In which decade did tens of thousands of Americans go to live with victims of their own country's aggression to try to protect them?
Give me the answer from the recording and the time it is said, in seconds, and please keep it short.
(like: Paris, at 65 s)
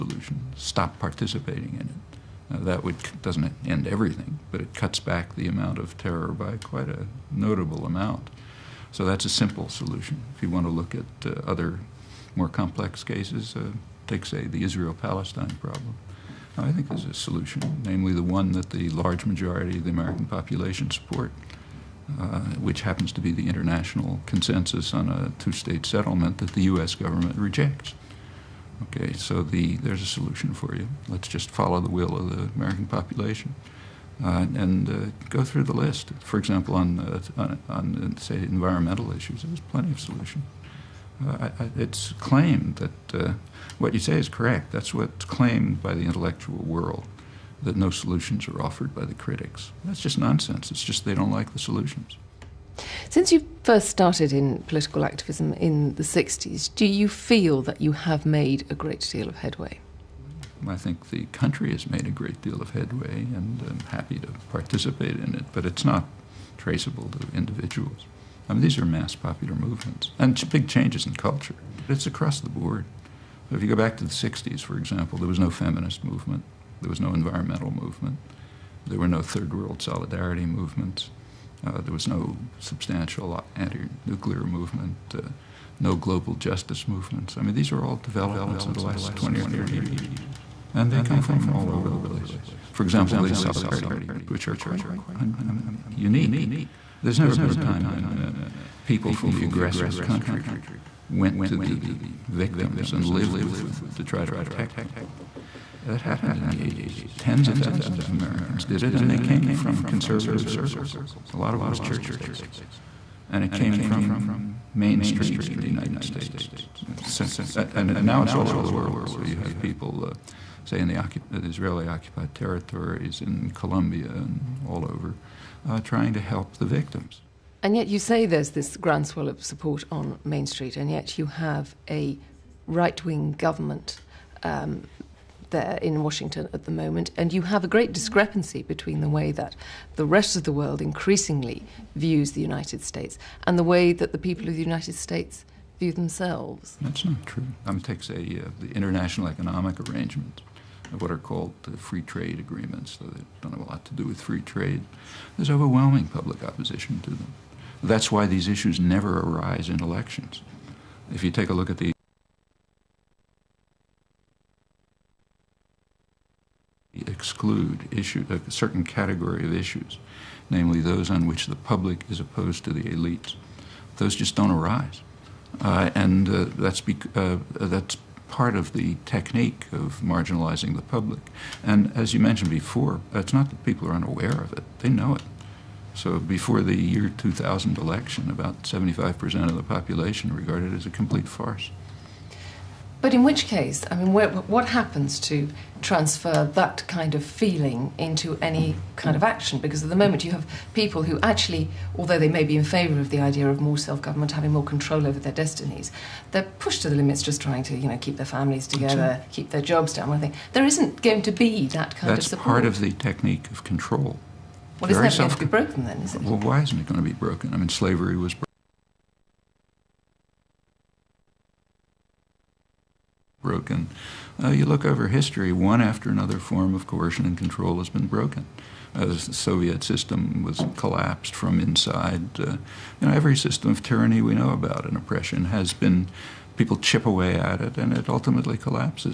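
the 80s, at 106 s.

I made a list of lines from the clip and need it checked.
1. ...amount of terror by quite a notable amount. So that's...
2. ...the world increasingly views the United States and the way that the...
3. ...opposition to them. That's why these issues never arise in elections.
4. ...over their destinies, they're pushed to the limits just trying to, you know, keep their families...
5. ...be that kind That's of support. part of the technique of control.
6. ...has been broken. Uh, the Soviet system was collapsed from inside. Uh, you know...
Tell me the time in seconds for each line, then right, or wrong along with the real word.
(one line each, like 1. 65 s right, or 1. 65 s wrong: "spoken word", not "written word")
1. 5 s right
2. 140 s right
3. 156 s right
4. 205 s right
5. 211 s right
6. 227 s right.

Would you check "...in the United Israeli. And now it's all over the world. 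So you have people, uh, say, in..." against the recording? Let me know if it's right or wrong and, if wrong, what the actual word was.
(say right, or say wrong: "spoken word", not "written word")
wrong: "States", not "Israeli".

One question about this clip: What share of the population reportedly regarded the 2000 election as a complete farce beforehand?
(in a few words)
75%.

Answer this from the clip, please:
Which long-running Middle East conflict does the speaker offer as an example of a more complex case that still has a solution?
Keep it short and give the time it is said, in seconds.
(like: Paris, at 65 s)
Israel Palestine, at 14 s.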